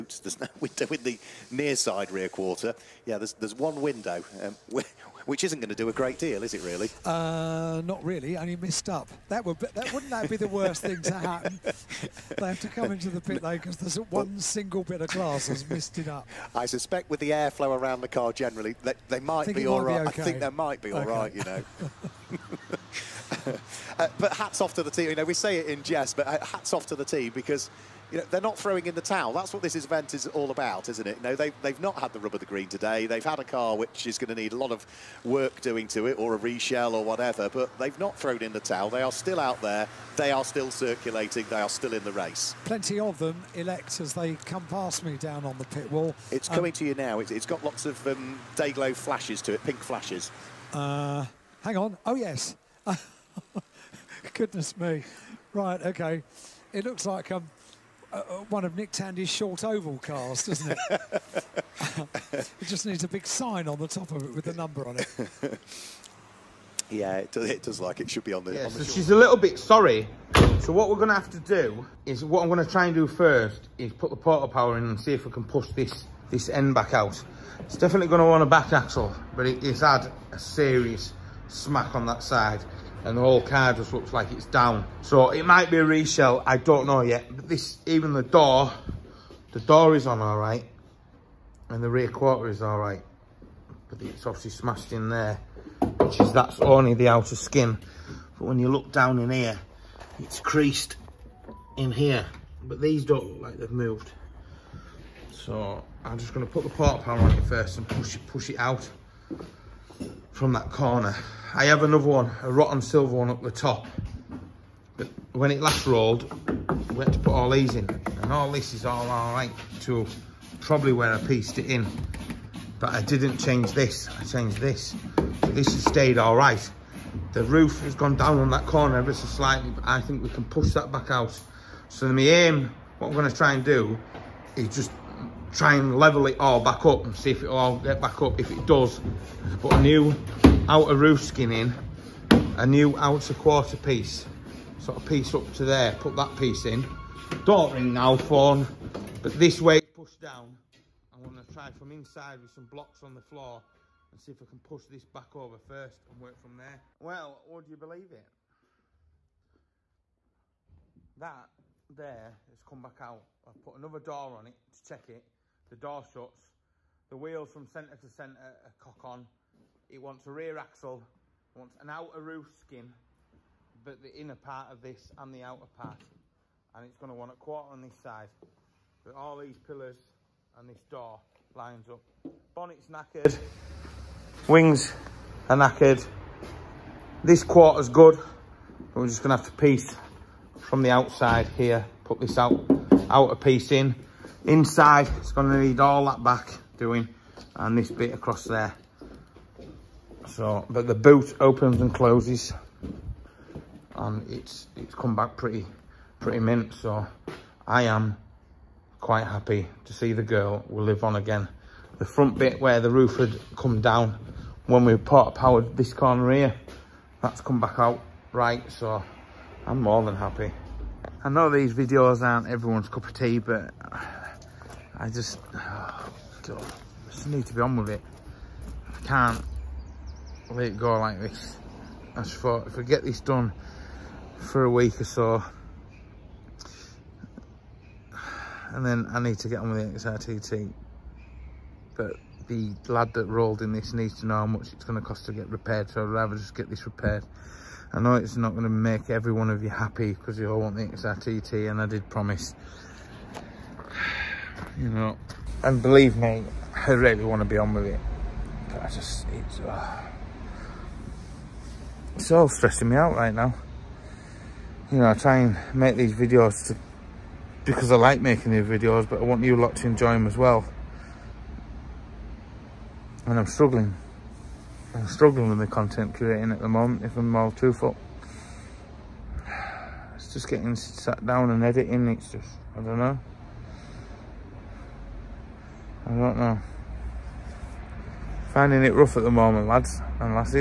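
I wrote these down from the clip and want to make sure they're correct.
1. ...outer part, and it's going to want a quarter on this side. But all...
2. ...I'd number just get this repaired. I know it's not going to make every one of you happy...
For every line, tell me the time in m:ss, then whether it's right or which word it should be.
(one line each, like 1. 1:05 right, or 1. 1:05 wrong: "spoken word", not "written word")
1. 2:55 right
2. 4:06 wrong: "rather", not "number".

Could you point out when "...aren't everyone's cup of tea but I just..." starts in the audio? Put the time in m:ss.
3:42.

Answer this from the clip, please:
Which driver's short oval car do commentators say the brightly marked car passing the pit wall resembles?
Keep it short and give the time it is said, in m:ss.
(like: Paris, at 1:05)
Nick Tandy, at 0:58.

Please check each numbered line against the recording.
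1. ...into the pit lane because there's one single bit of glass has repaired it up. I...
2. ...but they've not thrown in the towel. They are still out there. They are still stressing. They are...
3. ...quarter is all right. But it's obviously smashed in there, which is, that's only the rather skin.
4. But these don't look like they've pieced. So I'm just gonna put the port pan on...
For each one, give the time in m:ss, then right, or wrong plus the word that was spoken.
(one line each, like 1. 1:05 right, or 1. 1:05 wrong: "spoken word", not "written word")
1. 0:12 wrong: "missed", not "repaired"
2. 0:37 wrong: "circulating", not "stressing"
3. 1:32 wrong: "outer", not "rather"
4. 1:42 wrong: "moved", not "pieced".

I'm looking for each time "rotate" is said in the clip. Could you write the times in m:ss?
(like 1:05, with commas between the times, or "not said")
not said.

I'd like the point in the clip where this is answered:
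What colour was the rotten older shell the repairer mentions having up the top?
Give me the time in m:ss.
1:52.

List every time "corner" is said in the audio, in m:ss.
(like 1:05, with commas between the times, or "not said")
1:50, 2:08, 3:35.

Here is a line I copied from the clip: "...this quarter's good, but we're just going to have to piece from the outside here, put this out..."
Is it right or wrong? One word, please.
right.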